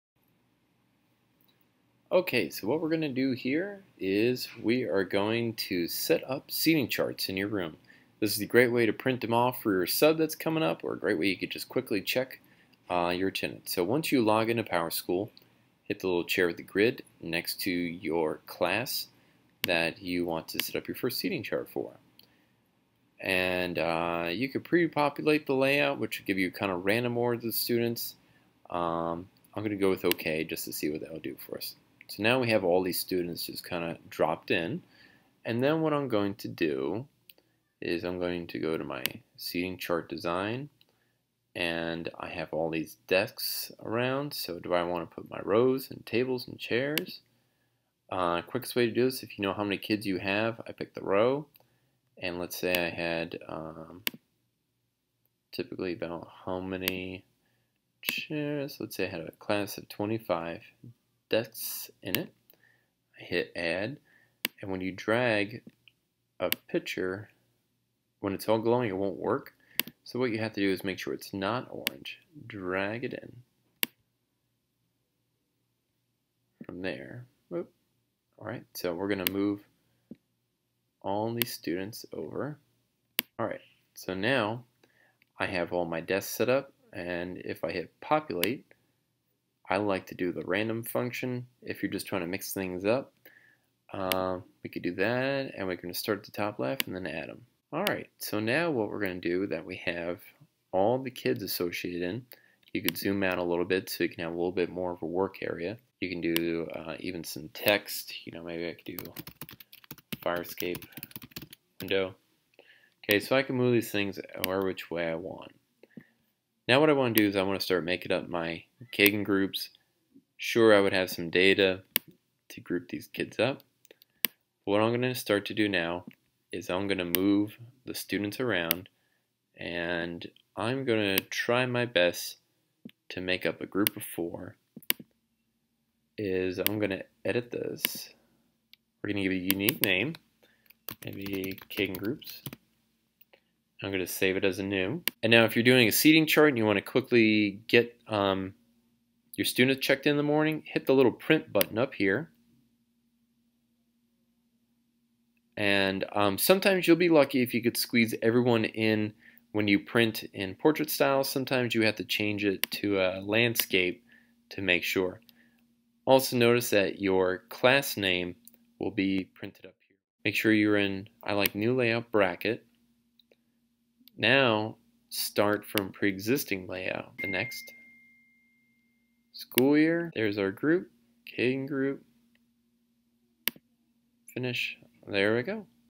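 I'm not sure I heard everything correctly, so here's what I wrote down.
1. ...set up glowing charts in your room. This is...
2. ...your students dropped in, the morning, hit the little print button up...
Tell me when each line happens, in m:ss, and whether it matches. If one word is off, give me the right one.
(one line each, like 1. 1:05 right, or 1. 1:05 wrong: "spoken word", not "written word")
1. 0:05 wrong: "seating", not "glowing"
2. 2:29 wrong: "checked", not "dropped".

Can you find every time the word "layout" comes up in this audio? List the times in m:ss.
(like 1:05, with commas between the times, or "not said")
0:25, 2:51, 2:56.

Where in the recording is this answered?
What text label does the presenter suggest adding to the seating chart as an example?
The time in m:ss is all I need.
1:50.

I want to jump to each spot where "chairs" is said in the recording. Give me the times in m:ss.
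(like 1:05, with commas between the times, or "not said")
0:16, 0:46, 0:58.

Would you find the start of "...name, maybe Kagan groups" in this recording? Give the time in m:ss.
2:19.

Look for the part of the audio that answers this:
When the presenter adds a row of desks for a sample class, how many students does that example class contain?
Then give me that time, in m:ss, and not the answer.
0:59.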